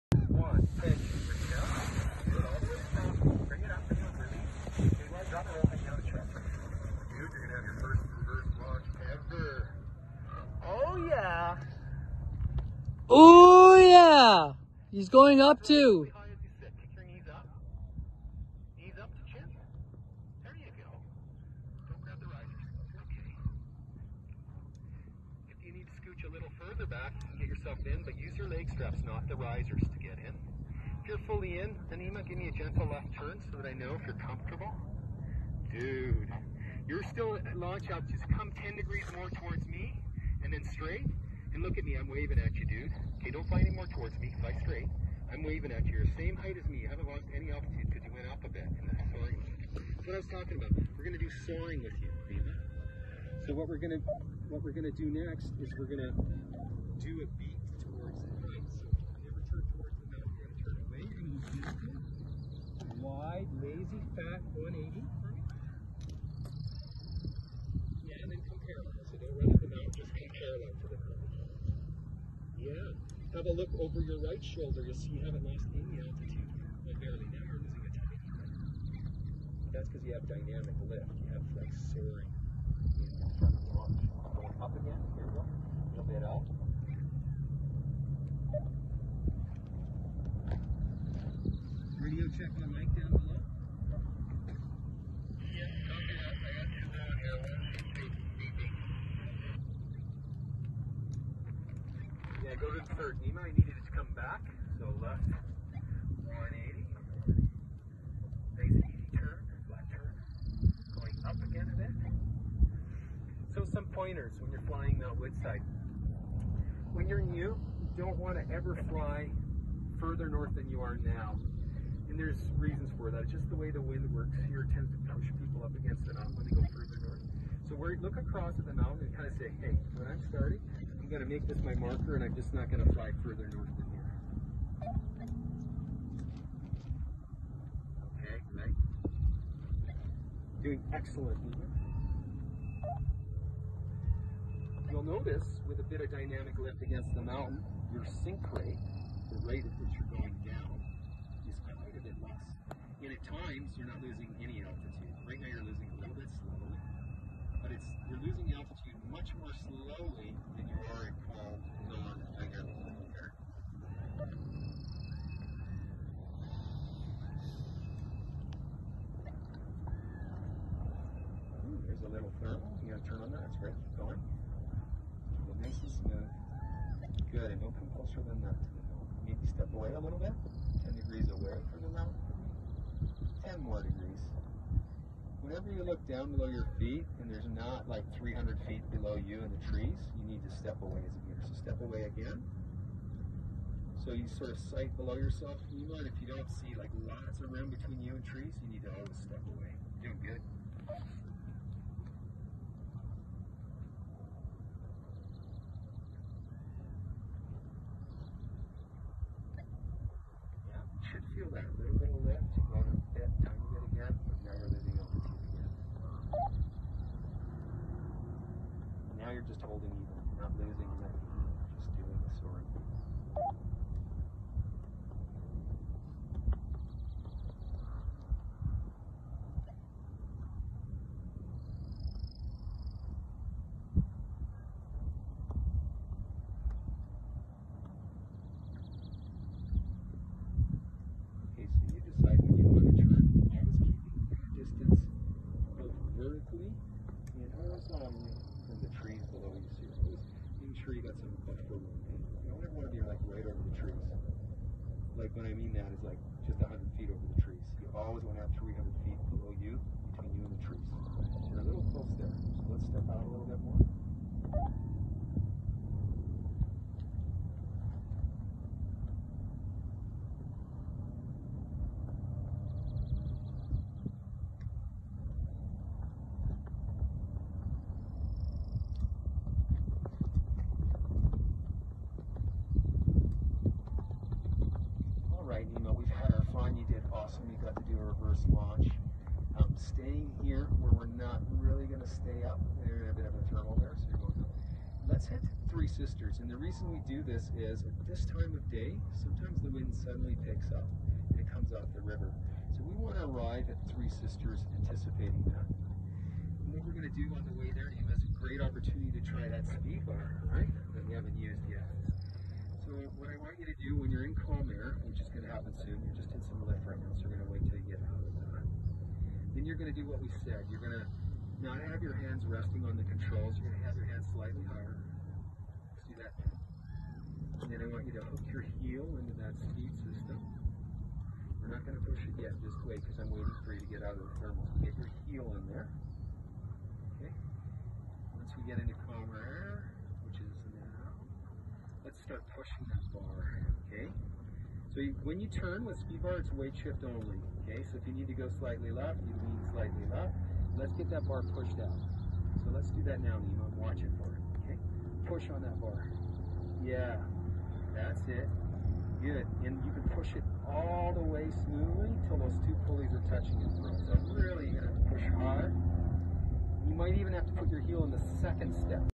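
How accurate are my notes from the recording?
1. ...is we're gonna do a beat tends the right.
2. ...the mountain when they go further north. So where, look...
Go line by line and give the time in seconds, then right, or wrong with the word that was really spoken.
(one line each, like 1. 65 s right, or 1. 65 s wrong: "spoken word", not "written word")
1. 55 s wrong: "towards", not "tends"
2. 126 s right.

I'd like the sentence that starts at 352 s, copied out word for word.
So let's do that now, Nemo.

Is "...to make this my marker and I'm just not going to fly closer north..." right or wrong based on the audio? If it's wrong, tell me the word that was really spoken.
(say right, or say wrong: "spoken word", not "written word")
wrong: "further", not "closer".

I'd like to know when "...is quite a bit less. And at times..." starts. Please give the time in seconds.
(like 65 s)
151 s.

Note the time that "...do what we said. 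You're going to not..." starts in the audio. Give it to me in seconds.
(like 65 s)
319 s.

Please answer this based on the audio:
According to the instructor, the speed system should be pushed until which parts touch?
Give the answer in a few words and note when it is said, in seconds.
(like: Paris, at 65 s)
two pulleys, at 362 s.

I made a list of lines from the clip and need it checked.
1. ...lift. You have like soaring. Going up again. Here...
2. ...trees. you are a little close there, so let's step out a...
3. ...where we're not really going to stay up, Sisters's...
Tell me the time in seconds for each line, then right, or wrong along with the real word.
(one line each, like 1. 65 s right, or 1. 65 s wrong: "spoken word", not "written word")
1. 80 s right
2. 260 s right
3. 290 s wrong: "There", not "Sisters".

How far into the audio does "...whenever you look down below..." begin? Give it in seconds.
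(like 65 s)
185 s.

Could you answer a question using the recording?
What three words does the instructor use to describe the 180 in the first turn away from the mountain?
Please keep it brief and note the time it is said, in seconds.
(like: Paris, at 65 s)
wide, lazy, fat, at 62 s.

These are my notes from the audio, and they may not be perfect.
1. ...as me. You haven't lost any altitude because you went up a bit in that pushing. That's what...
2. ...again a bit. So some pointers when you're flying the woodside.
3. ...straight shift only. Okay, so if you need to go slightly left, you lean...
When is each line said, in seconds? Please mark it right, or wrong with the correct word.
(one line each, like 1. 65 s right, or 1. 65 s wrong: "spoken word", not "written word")
1. 46 s wrong: "soaring", not "pushing"
2. 111 s right
3. 346 s wrong: "weight", not "straight".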